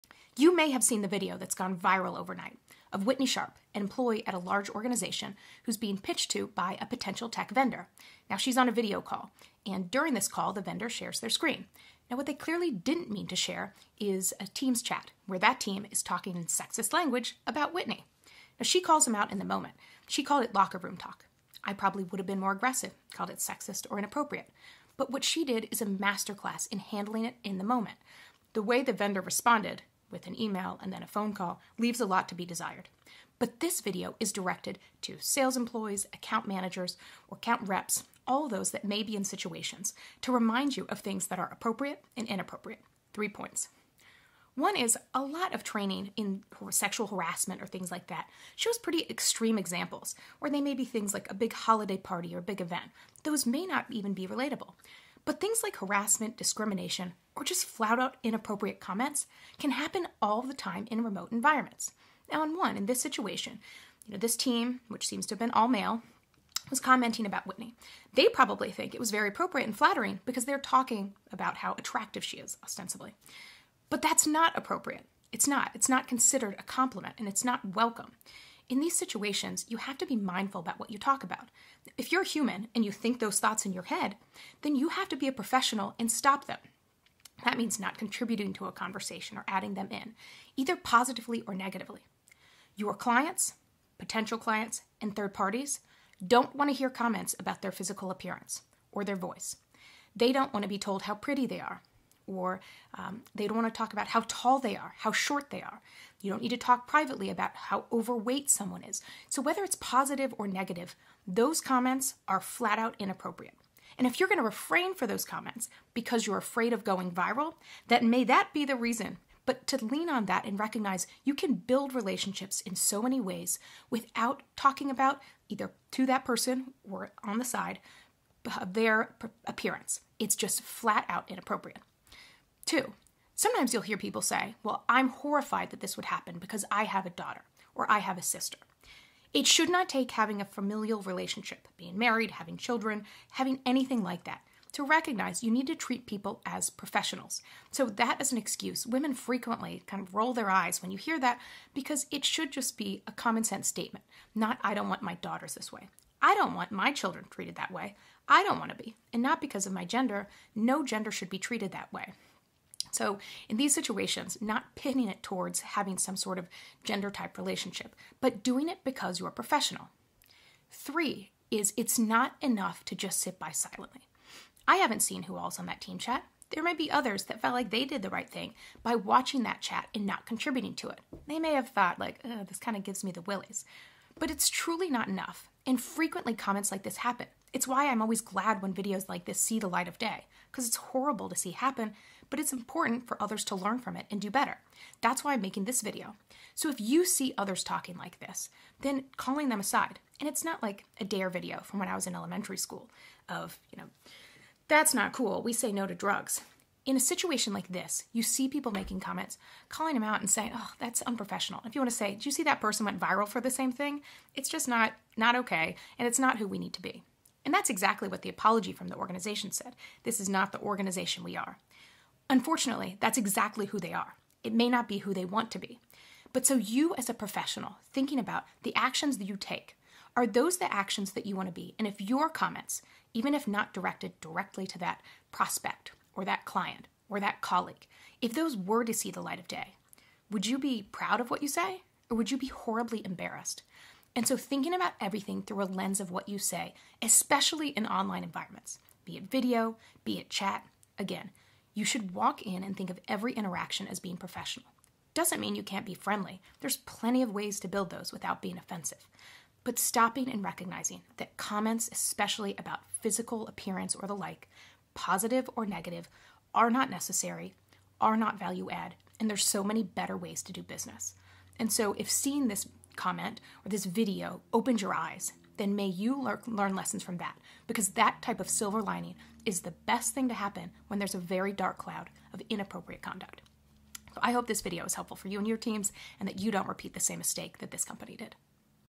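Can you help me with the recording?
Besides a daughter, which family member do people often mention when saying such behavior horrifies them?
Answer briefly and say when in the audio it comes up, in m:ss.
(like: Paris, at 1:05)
sister, at 2:18.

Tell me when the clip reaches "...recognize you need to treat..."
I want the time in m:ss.
2:24.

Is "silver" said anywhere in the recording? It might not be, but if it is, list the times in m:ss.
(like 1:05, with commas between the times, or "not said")
4:38.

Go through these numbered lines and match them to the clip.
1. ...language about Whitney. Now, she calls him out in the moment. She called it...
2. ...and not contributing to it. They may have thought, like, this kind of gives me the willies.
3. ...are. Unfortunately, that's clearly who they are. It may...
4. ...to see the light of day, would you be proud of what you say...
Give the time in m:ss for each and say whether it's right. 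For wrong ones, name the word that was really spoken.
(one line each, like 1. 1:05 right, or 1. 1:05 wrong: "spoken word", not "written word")
1. 0:16 right
2. 2:59 right
3. 3:41 wrong: "exactly", not "clearly"
4. 3:58 right.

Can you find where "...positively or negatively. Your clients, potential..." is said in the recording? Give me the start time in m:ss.
1:30.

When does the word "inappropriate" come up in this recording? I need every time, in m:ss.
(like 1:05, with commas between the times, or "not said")
0:23, 0:42, 0:58, 1:52, 2:11, 4:42.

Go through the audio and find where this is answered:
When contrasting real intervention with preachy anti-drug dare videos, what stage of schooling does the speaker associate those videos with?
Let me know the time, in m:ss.
3:22.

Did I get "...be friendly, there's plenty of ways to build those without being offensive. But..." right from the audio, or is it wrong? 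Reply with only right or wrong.
right.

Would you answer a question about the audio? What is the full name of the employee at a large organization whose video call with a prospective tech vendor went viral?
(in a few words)
Whitney Sharpe.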